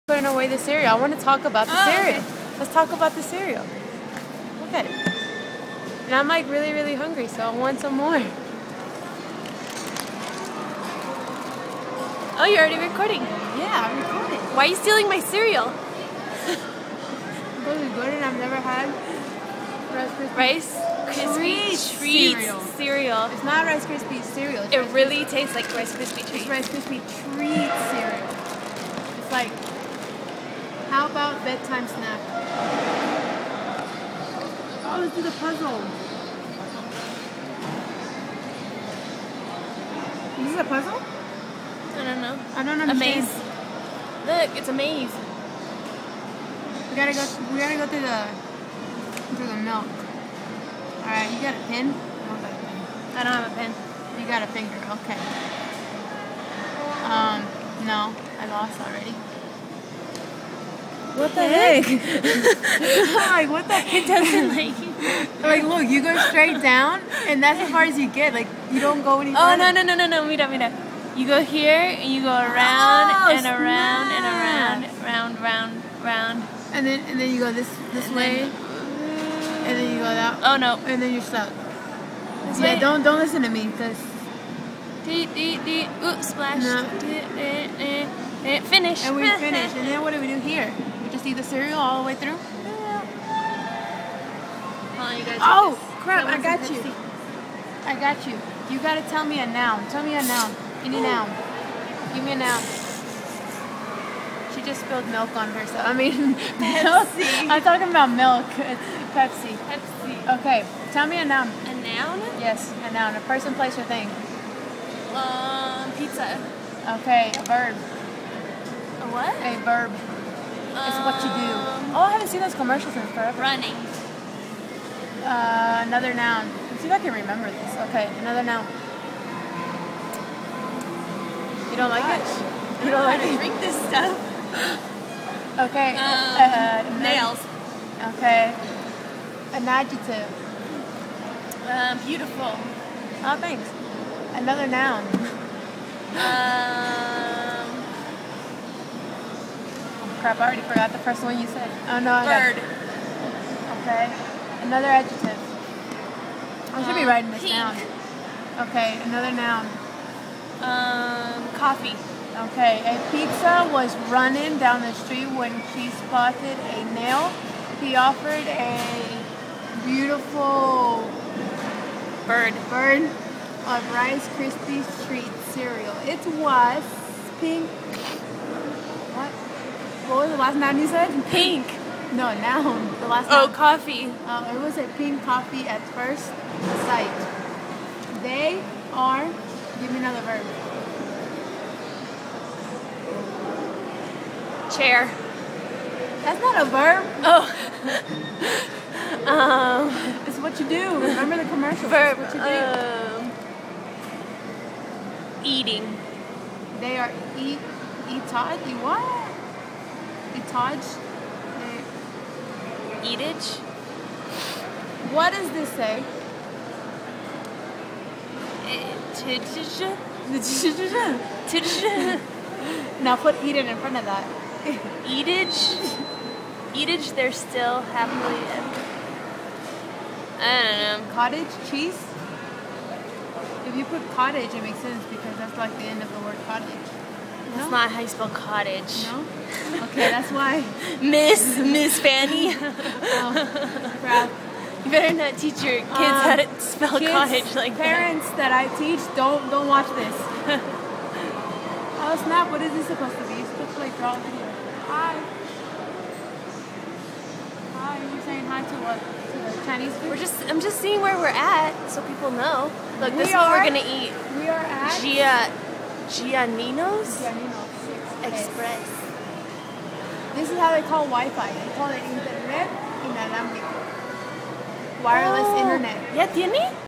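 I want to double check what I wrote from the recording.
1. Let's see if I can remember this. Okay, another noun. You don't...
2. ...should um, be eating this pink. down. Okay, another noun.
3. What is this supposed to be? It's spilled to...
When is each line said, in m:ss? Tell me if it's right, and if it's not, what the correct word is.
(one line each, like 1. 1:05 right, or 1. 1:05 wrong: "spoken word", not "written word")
1. 2:06 right
2. 2:36 wrong: "writing", not "eating"
3. 4:12 wrong: "supposed", not "spilled".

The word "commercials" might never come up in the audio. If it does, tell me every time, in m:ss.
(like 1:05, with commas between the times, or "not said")
2:02, 3:21.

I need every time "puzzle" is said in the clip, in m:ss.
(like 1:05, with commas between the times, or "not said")
0:35, 0:40.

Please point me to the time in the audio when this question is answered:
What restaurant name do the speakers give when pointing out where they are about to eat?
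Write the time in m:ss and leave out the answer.
4:27.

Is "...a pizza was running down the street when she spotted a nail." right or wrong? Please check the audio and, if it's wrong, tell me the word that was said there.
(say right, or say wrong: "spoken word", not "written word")
right.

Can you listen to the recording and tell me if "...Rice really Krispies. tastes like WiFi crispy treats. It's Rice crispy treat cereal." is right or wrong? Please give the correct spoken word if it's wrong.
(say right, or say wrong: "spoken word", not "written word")
wrong: "Rice", not "WiFi".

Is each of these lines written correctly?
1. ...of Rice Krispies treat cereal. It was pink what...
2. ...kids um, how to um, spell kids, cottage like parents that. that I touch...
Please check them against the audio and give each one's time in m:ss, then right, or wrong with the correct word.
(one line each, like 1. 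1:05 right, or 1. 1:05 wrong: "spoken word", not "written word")
1. 2:53 right
2. 4:05 wrong: "teach", not "touch".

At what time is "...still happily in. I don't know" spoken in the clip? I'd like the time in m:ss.
3:47.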